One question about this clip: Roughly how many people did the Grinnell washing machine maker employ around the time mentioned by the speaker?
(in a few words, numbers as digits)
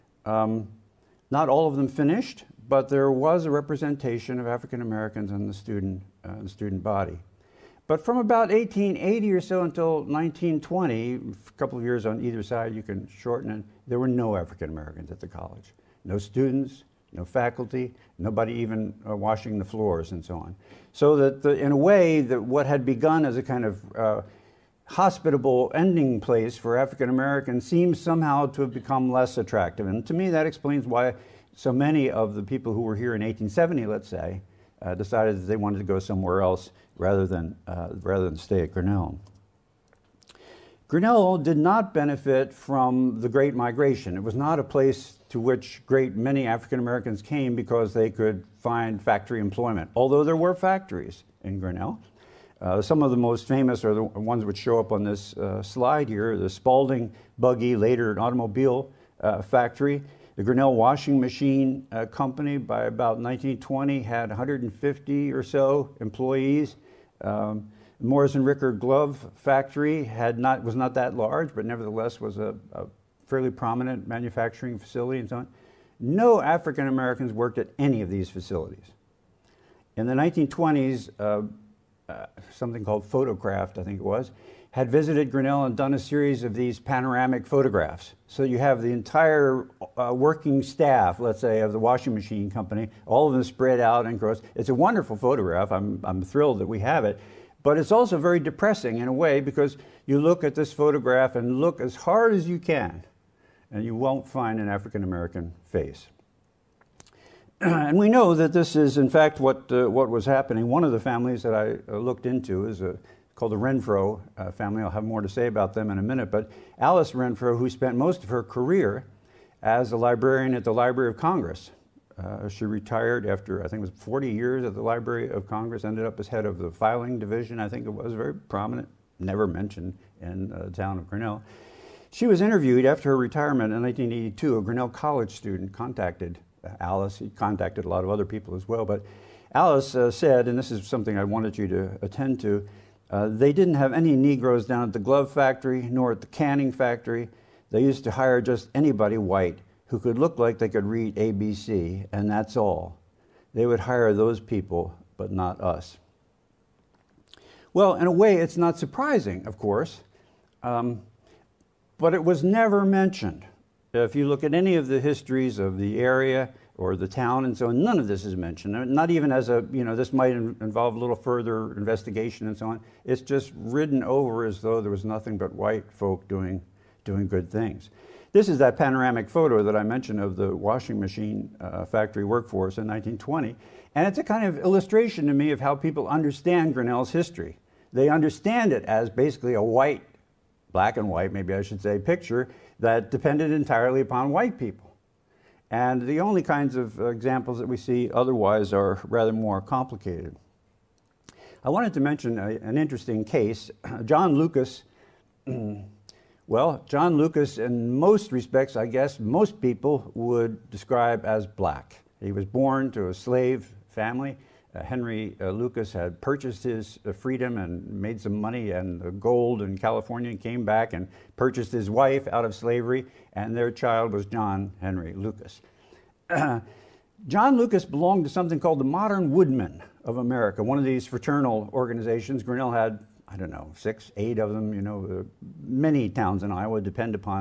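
150.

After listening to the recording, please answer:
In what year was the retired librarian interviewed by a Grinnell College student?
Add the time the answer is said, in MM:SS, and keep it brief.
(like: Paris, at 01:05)
1982, at 02:13.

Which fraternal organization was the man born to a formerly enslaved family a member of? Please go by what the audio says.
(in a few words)
Modern Woodmen of America.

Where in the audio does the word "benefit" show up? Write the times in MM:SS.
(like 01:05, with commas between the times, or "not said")
00:41.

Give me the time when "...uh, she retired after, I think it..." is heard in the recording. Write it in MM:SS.
02:02.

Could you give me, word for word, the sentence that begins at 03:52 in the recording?
Grinnell had, I don't know, six, eight of them.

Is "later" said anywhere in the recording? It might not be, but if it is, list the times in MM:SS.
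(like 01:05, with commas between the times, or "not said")
00:57.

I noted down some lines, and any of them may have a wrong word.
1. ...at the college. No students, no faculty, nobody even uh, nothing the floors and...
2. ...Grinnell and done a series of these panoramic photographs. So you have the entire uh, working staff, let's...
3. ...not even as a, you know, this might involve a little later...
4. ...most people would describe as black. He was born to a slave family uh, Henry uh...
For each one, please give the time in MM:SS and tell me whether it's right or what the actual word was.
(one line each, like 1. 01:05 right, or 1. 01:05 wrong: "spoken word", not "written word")
1. 00:15 wrong: "washing", not "nothing"
2. 01:25 right
3. 02:48 wrong: "further", not "later"
4. 03:29 right.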